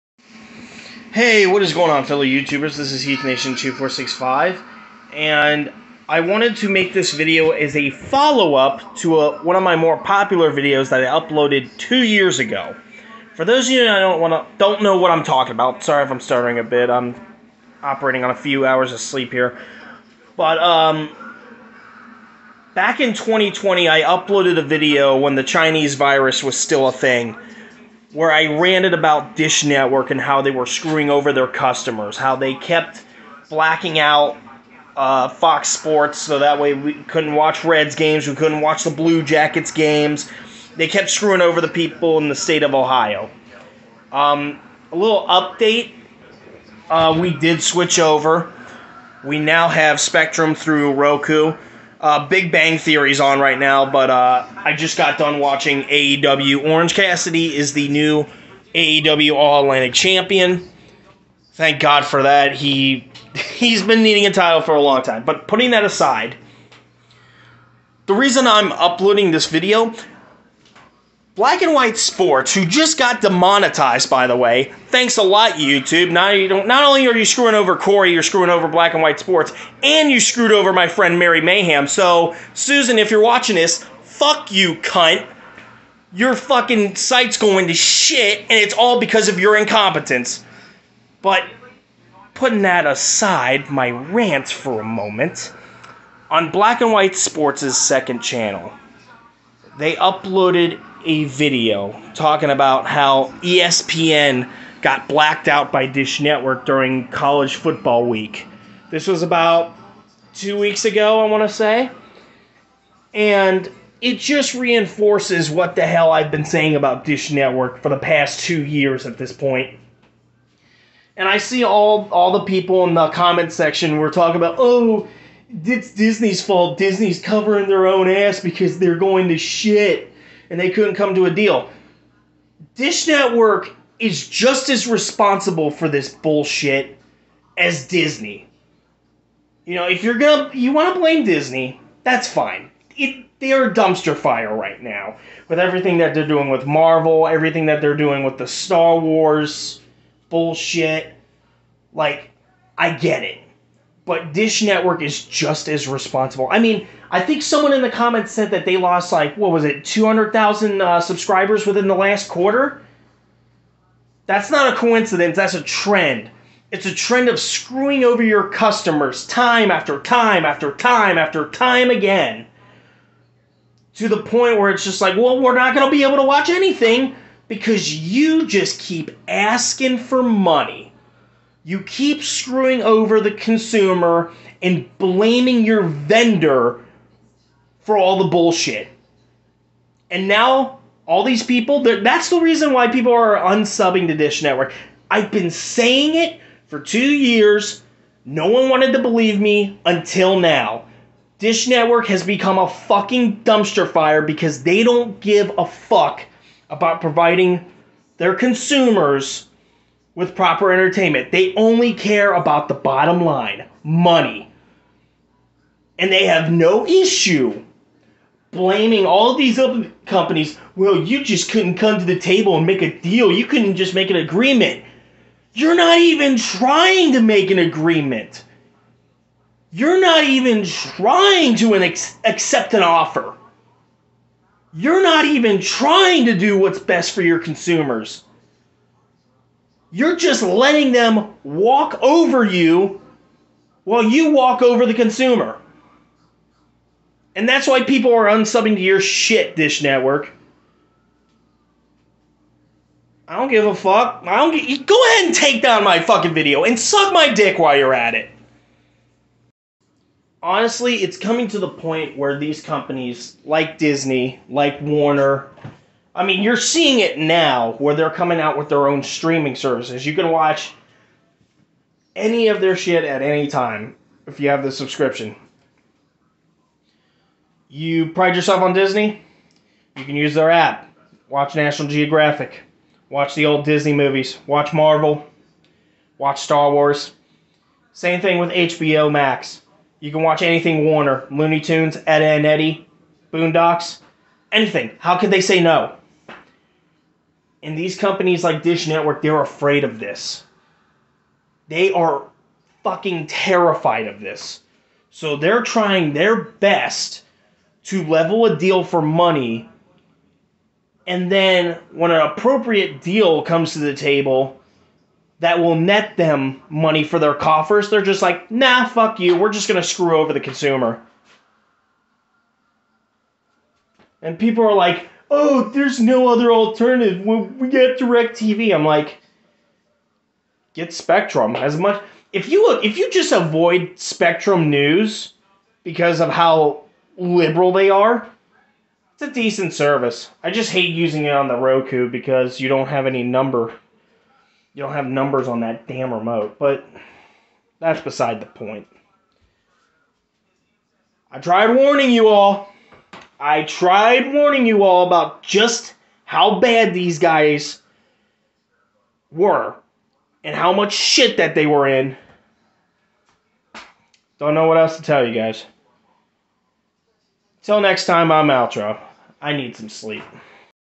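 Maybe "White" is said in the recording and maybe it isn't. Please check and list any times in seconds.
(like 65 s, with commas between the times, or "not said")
71 s, 79 s, 96 s.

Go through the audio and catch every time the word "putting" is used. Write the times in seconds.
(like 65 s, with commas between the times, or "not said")
65 s, 92 s.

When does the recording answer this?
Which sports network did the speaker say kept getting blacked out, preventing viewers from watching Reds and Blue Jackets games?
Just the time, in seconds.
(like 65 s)
35 s.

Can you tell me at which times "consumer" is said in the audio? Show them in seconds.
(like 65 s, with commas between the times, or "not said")
183 s, 208 s, 237 s, 244 s, 320 s.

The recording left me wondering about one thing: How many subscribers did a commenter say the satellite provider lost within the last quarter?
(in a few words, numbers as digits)
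200,000.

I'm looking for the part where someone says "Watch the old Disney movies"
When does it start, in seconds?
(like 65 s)
283 s.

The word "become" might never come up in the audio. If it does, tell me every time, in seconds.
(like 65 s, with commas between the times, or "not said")
202 s.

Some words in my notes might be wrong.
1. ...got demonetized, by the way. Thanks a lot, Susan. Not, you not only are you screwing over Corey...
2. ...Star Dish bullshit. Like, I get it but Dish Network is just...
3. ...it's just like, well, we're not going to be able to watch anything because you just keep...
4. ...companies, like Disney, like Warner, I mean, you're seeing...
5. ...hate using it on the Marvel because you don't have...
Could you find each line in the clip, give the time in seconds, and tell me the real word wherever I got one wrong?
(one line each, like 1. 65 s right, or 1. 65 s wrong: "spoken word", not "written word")
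1. 72 s wrong: "YouTube", not "Susan"
2. 148 s wrong: "Wars", not "Dish"
3. 174 s right
4. 262 s right
5. 340 s wrong: "Roku", not "Marvel".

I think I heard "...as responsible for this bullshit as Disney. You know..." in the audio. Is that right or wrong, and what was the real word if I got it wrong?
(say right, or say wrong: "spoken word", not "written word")
right.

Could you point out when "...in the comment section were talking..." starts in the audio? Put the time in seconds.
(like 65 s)
122 s.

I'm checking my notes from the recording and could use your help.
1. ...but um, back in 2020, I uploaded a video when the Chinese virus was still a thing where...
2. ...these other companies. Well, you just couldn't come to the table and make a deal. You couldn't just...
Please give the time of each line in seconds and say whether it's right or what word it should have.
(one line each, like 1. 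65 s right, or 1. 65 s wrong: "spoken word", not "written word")
1. 20 s right
2. 219 s right.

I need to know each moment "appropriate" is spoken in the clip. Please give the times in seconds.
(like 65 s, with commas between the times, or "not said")
312 s.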